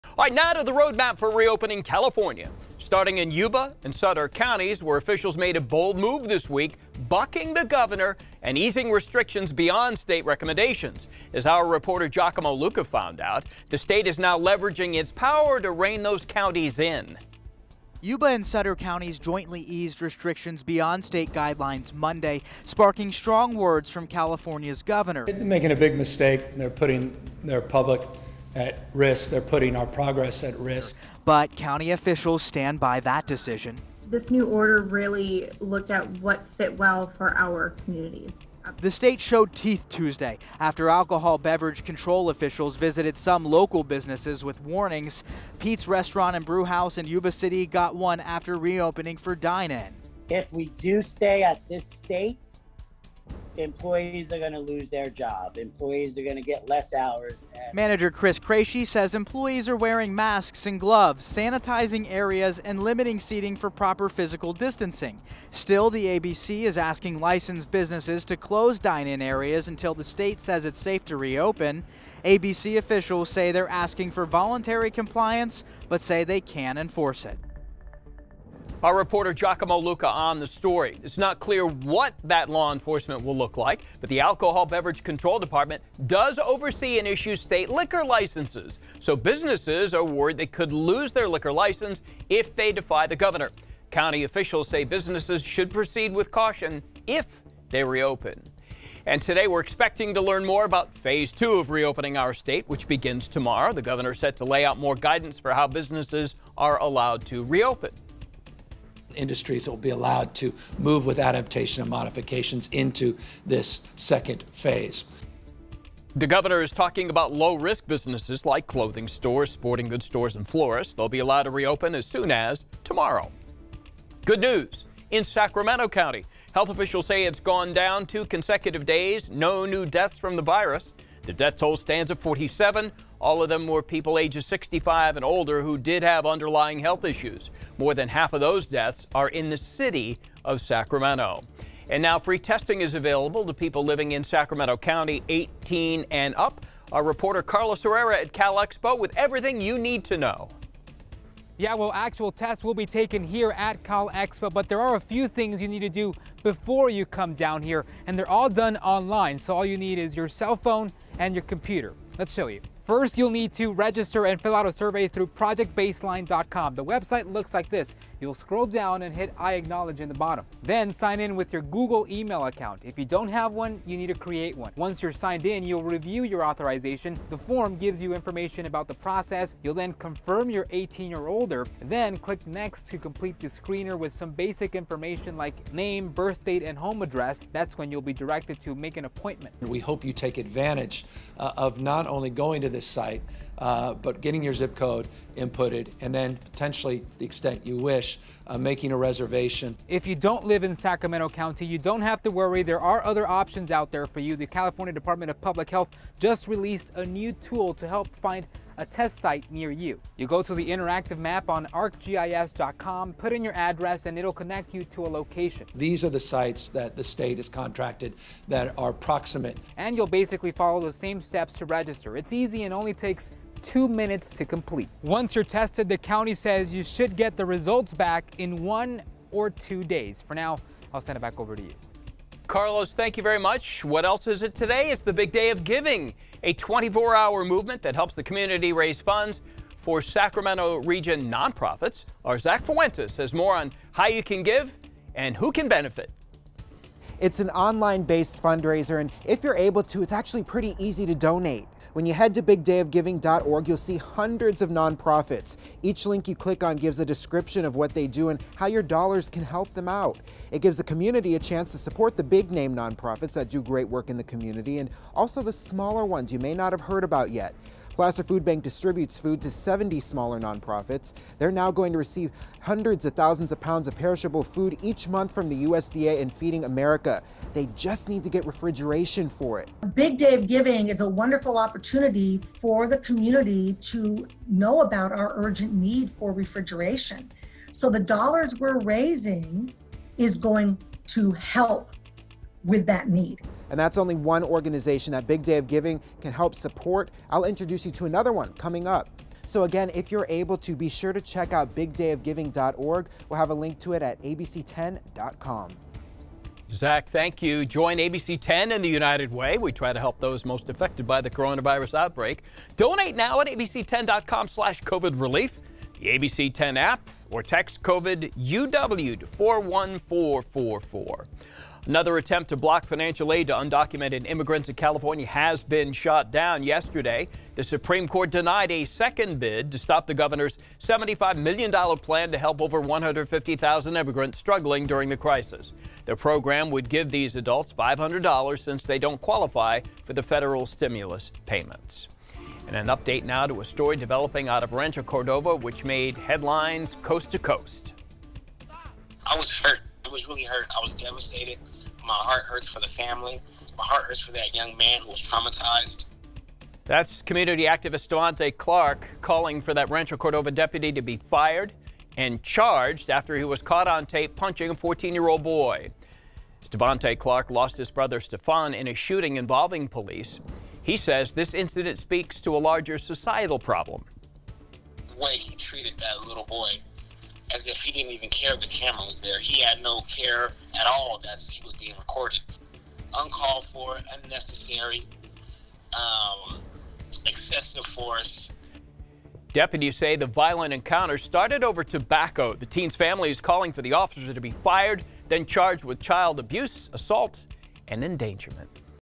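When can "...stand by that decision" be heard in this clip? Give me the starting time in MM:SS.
00:32.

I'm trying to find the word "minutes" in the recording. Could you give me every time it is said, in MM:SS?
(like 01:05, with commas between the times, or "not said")
03:43.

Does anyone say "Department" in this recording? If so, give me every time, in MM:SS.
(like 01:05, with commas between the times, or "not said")
01:25, 03:24.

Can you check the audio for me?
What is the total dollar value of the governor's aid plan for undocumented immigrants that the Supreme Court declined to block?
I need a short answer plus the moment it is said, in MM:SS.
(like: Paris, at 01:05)
$75 million, at 05:30.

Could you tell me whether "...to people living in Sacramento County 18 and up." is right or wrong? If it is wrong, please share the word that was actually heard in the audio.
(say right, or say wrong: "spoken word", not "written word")
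right.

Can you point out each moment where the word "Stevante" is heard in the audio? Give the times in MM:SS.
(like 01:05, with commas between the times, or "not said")
05:58, 06:06.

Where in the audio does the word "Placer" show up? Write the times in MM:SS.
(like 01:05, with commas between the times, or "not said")
04:27.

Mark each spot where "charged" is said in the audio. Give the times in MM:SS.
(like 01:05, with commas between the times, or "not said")
06:02, 06:35.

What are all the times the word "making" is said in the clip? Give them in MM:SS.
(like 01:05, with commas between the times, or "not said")
00:25, 03:18.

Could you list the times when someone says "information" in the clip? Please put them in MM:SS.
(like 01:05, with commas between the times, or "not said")
02:58, 03:04.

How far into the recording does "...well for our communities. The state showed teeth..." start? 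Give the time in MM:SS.
00:36.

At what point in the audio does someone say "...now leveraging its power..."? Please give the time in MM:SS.
00:14.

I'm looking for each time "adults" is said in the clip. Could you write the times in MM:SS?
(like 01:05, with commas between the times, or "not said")
05:37.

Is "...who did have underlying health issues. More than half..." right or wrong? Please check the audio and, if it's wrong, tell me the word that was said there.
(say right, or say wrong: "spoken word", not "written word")
right.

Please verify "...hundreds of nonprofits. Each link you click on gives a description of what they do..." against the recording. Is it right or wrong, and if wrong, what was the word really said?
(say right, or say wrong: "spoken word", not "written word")
right.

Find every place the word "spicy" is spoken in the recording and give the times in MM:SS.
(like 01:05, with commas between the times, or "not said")
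not said.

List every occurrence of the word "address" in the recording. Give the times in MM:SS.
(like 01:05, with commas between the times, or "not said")
03:07, 03:33.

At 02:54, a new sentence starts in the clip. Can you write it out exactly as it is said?
Once you're signed in, you'll review your authorization.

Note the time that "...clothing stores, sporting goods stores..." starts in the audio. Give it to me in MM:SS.
01:58.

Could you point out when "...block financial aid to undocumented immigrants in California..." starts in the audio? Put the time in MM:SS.
05:22.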